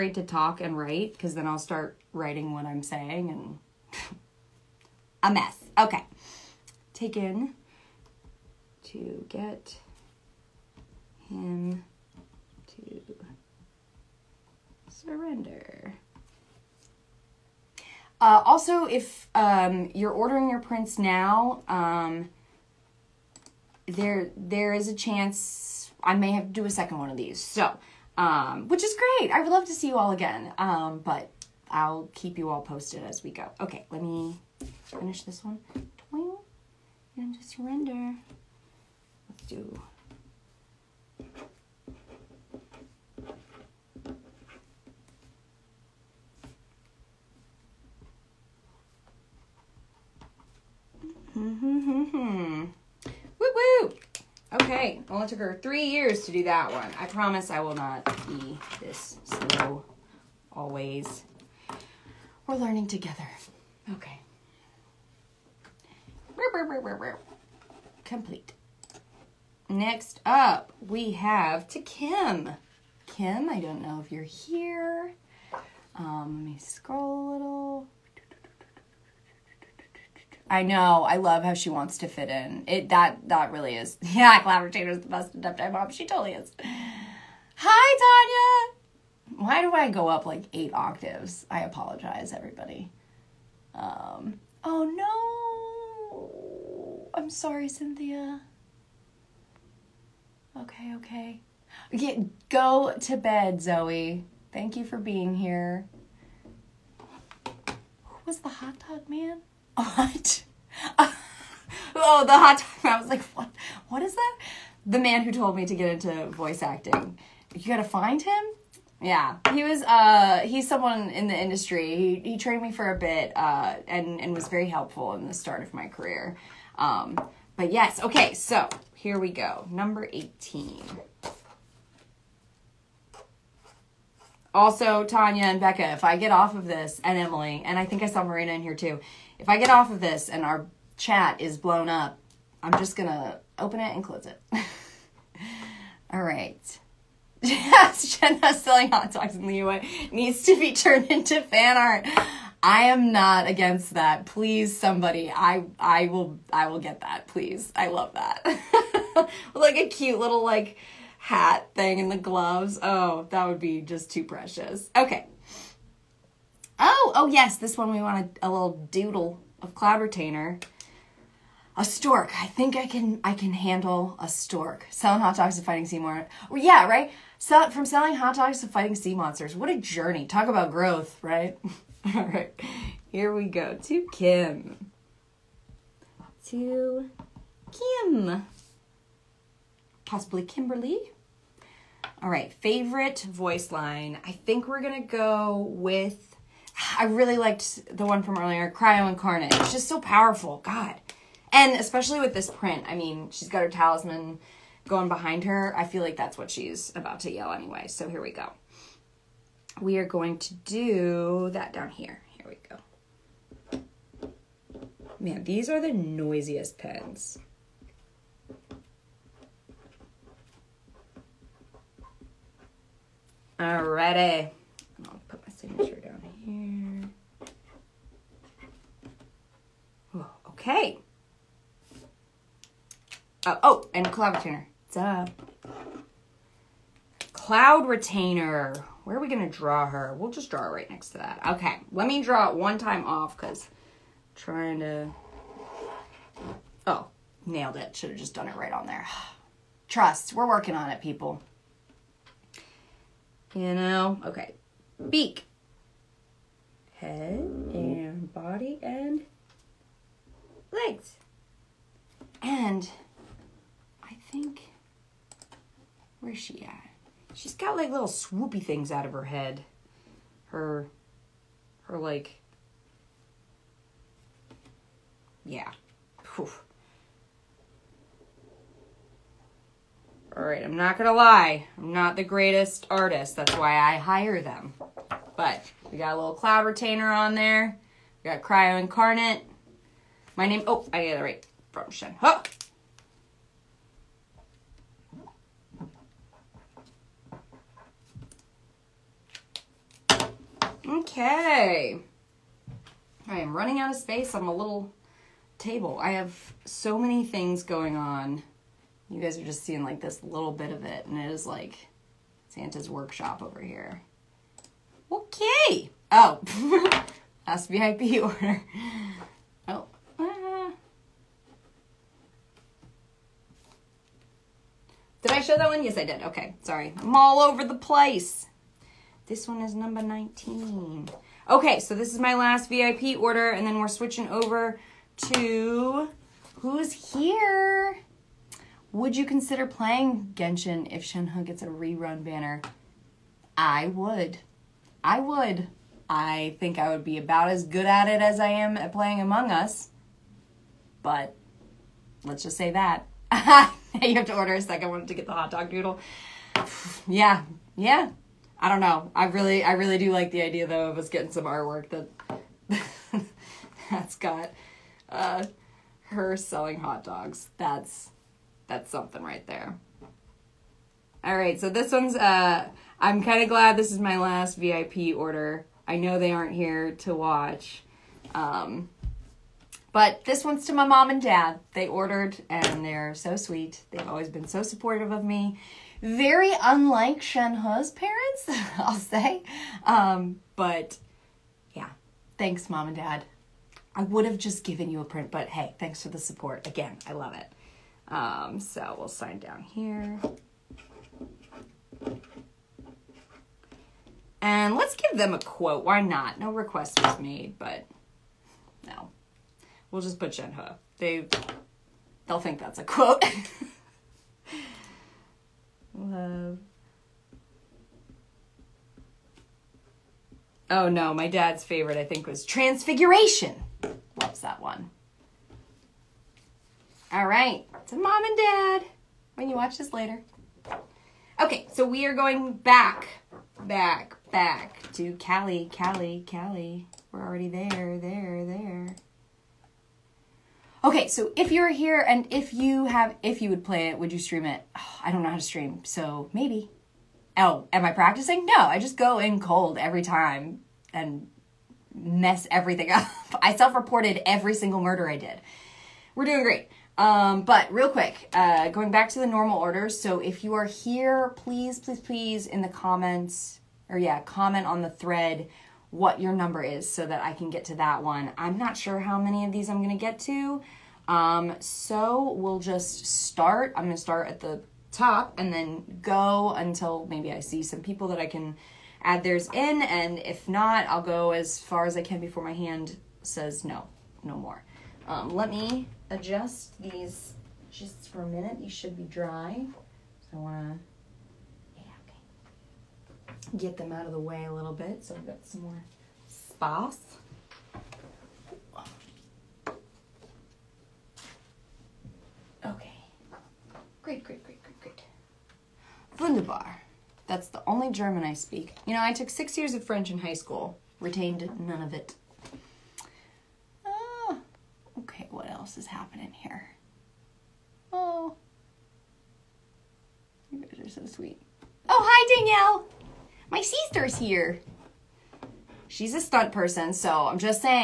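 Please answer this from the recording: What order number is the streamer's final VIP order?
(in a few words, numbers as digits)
19.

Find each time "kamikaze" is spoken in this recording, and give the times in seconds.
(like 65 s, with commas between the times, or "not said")
not said.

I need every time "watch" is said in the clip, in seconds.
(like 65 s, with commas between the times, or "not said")
377 s, 429 s.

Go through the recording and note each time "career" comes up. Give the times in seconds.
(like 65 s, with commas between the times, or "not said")
125 s.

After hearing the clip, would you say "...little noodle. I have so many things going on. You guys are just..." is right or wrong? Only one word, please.
wrong.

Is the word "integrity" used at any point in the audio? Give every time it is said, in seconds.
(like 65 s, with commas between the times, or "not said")
not said.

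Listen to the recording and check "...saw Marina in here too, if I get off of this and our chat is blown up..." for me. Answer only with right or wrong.
right.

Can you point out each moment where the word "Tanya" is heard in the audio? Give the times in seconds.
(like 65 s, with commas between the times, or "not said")
89 s, 135 s.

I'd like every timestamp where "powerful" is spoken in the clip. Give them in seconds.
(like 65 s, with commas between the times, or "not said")
199 s.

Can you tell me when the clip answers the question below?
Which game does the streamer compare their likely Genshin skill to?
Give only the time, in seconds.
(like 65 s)
349 s.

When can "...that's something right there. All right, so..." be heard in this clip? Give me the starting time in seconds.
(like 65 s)
368 s.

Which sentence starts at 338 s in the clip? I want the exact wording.
Would you consider playing Genshin if Shenhe gets a rerun banner?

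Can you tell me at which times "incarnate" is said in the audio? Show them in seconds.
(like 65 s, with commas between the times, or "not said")
199 s, 288 s.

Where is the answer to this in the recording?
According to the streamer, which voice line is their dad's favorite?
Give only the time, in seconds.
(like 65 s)
422 s.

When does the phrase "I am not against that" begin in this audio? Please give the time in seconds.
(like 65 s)
152 s.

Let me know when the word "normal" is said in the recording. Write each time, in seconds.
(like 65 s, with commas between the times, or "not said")
459 s.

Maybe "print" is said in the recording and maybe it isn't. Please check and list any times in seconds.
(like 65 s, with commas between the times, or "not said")
20 s, 202 s, 395 s.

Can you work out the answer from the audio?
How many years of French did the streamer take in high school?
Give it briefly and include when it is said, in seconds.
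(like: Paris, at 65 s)
6, at 509 s.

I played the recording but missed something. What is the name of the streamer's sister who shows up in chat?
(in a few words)
Danielle.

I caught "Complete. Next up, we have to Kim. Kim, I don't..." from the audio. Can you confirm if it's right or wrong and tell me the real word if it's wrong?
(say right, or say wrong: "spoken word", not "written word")
right.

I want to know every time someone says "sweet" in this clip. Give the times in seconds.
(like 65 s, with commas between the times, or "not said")
383 s, 521 s.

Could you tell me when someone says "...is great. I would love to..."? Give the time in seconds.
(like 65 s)
28 s.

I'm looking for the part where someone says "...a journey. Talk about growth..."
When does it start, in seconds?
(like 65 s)
179 s.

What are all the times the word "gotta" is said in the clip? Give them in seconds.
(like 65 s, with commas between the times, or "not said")
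117 s.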